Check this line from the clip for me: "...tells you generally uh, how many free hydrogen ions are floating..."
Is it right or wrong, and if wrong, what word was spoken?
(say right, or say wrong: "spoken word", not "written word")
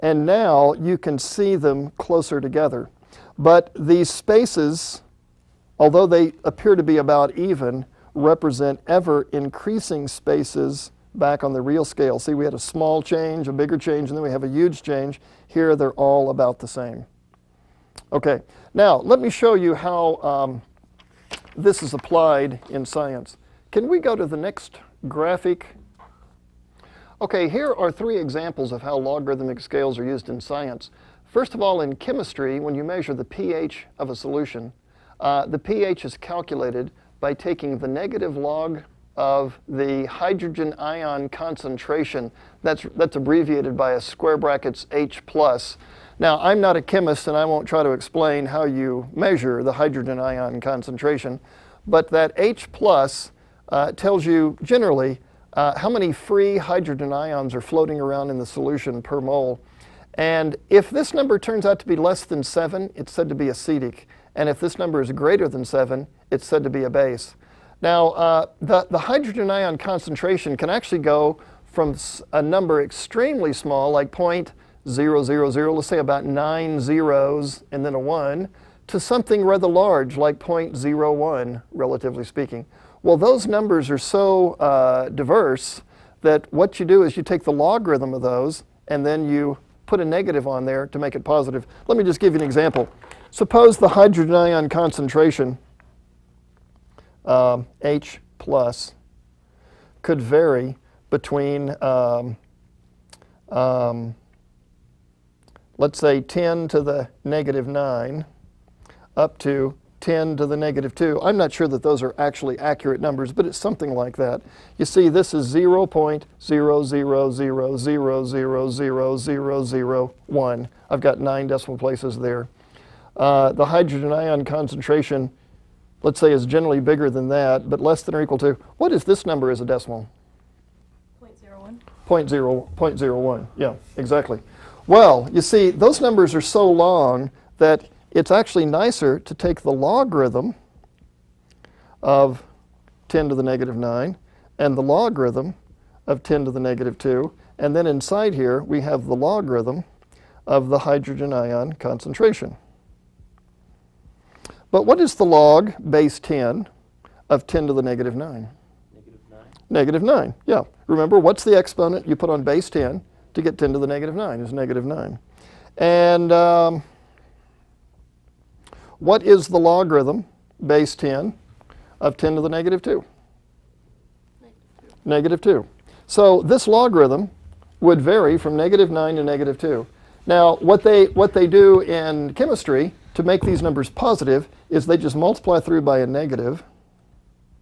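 right.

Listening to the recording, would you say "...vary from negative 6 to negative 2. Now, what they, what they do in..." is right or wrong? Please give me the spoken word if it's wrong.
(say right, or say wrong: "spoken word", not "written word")
wrong: "9", not "6".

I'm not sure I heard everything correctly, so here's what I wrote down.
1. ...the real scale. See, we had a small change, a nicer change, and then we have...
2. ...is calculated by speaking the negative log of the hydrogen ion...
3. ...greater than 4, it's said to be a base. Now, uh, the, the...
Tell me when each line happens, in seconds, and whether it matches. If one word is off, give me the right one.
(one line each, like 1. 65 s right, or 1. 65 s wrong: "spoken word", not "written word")
1. 11 s wrong: "bigger", not "nicer"
2. 36 s wrong: "taking", not "speaking"
3. 65 s wrong: "7", not "4".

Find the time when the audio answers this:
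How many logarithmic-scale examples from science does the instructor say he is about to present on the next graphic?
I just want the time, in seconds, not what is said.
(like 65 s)
27 s.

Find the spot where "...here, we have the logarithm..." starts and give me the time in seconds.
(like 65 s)
148 s.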